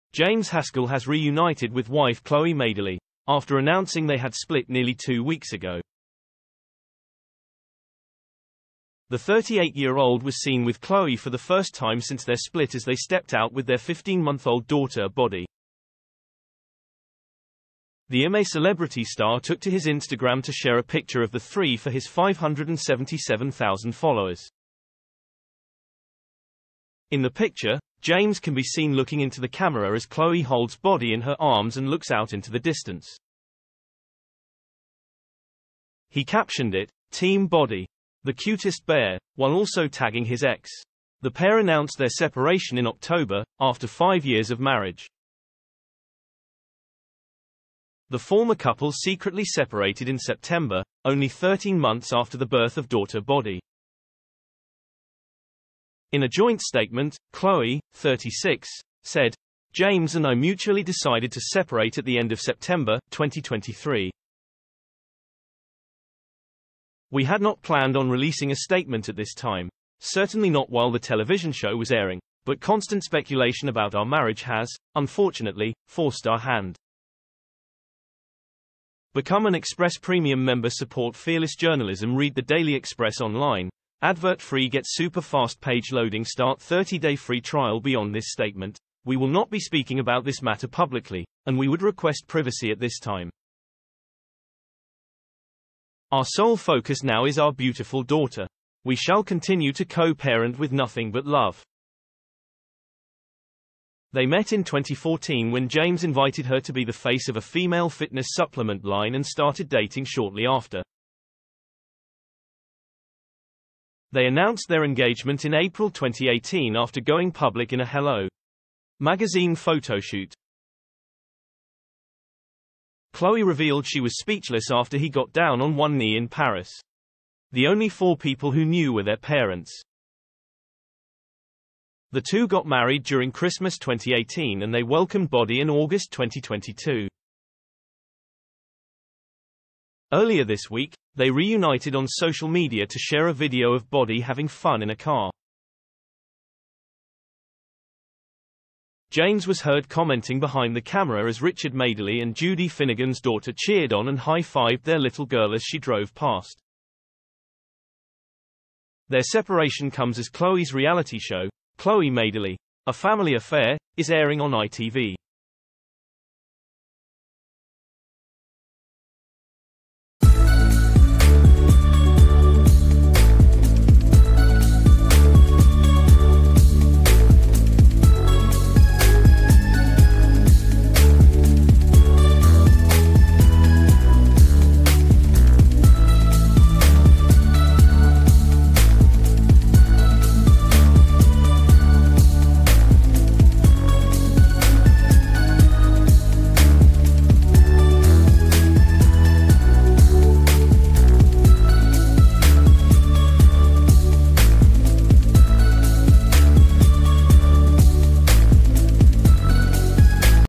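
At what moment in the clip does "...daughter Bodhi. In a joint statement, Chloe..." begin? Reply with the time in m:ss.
0:52.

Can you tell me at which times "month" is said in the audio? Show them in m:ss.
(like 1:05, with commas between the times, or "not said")
0:13, 0:51.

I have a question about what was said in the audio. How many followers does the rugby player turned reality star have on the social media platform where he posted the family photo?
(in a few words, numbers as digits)
577,000.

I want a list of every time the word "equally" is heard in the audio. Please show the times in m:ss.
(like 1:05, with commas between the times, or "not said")
not said.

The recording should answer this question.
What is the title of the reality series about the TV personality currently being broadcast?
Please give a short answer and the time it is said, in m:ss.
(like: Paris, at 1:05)
Chloe Madeley, A Family Affair, at 2:41.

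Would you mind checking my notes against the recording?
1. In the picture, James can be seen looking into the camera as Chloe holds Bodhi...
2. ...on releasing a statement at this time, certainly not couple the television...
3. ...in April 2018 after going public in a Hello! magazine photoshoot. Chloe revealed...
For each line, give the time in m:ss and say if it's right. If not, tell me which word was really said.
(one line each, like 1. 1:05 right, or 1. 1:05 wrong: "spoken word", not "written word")
1. 0:27 right
2. 1:07 wrong: "while", not "couple"
3. 1:55 right.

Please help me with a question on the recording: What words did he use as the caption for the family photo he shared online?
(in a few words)
Team Bodhi, the cutest bear.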